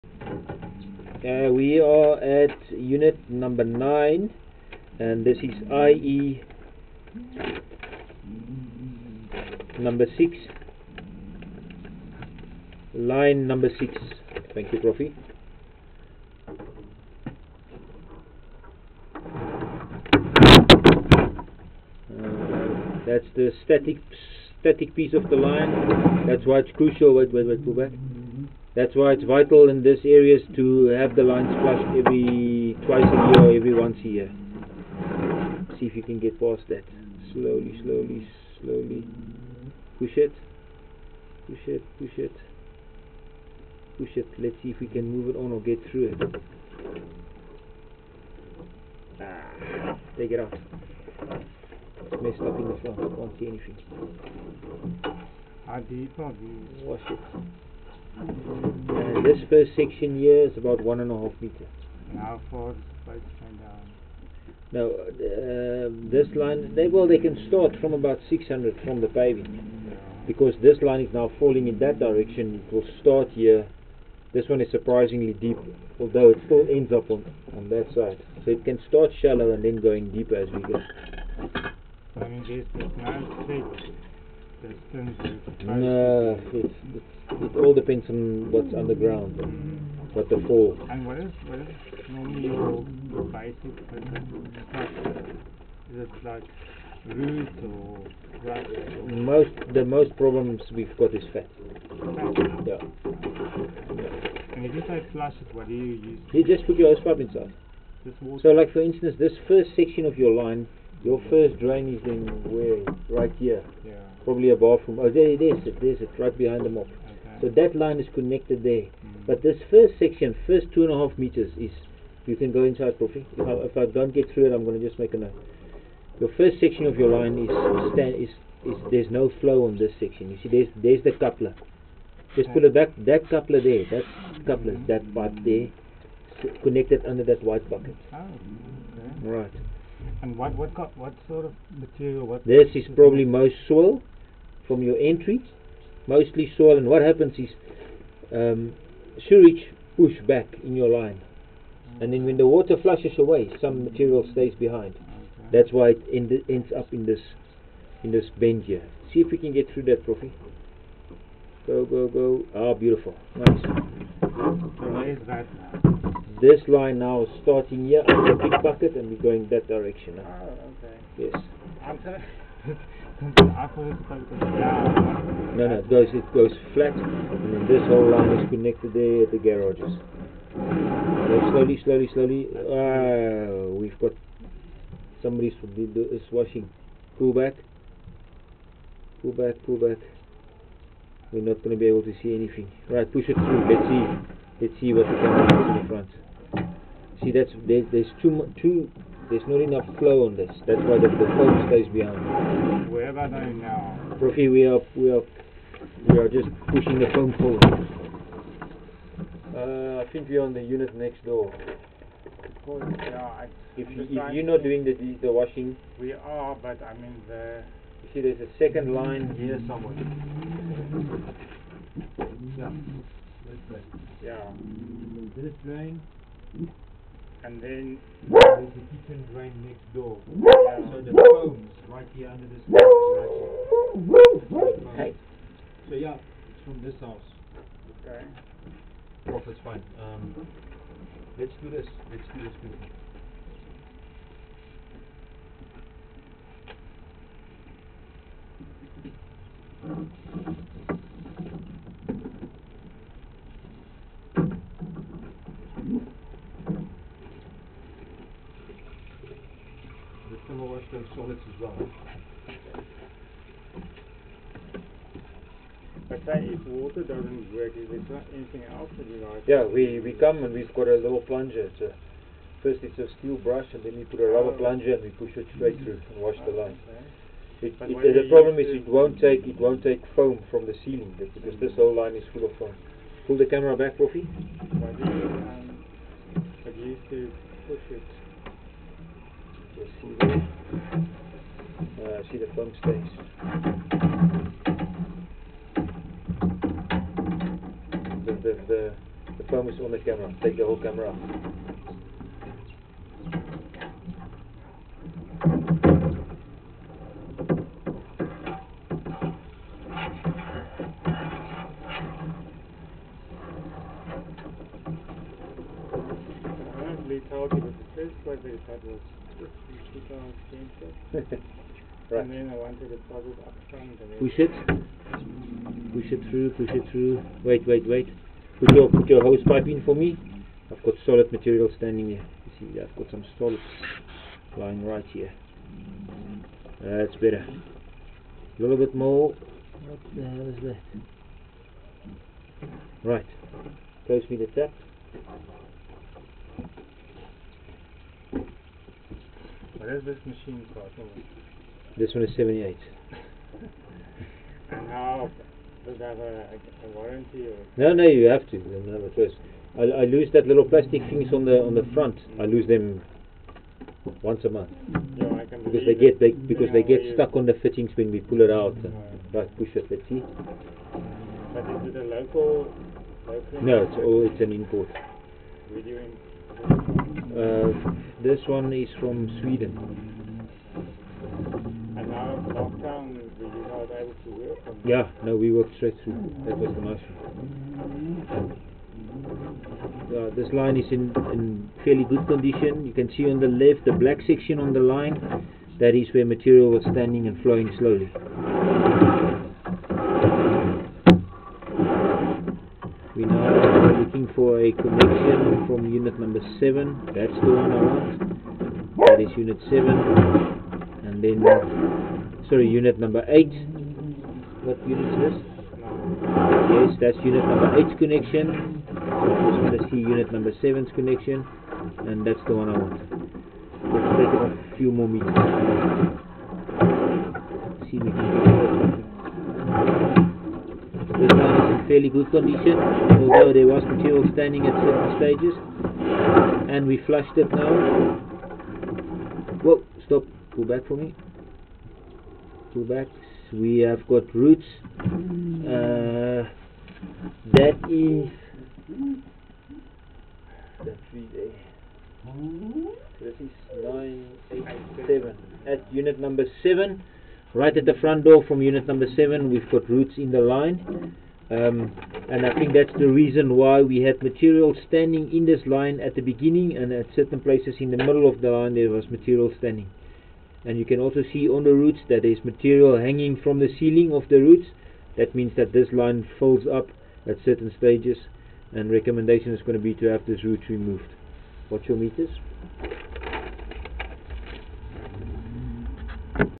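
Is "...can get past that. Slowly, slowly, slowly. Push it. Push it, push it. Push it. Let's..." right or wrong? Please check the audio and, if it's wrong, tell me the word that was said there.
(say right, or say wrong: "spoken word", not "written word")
right.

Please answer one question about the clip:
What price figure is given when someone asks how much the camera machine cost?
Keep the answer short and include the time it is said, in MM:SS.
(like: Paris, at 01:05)
78, at 05:52.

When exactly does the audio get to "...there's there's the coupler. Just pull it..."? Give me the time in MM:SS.
02:10.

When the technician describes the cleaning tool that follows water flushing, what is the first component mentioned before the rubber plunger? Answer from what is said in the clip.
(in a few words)
steel brush.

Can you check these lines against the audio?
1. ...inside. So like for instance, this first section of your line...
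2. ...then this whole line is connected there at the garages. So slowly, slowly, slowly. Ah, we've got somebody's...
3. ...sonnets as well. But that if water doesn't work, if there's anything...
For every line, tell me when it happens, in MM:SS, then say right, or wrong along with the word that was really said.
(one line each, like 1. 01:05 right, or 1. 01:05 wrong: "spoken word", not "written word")
1. 01:47 right
2. 02:57 right
3. 04:21 right.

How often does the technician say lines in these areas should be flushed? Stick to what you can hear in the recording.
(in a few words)
twice a year.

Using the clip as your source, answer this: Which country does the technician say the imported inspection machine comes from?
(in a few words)
Sweden.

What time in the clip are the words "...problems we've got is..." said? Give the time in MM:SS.
01:40.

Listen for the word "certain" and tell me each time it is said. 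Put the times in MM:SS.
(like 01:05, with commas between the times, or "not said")
07:14, 07:47, 07:57.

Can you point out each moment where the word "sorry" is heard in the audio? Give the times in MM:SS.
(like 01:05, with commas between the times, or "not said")
02:52, 06:52.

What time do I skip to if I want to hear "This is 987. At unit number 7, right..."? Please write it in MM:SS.
07:33.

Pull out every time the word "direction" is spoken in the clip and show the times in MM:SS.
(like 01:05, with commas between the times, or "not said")
01:11, 02:49.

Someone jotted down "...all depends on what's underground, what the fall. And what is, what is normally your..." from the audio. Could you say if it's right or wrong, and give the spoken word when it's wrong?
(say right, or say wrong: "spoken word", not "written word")
right.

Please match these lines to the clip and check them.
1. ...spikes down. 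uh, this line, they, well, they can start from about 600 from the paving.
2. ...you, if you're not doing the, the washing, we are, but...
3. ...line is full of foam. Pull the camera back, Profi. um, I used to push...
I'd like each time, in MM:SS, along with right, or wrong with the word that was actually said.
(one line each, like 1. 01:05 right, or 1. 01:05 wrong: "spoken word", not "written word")
1. 01:03 right
2. 03:33 right
3. 04:41 right.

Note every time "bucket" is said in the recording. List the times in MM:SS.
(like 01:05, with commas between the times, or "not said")
02:17, 02:48.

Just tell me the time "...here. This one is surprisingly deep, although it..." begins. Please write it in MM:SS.
01:13.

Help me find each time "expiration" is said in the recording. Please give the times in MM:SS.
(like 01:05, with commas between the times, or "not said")
not said.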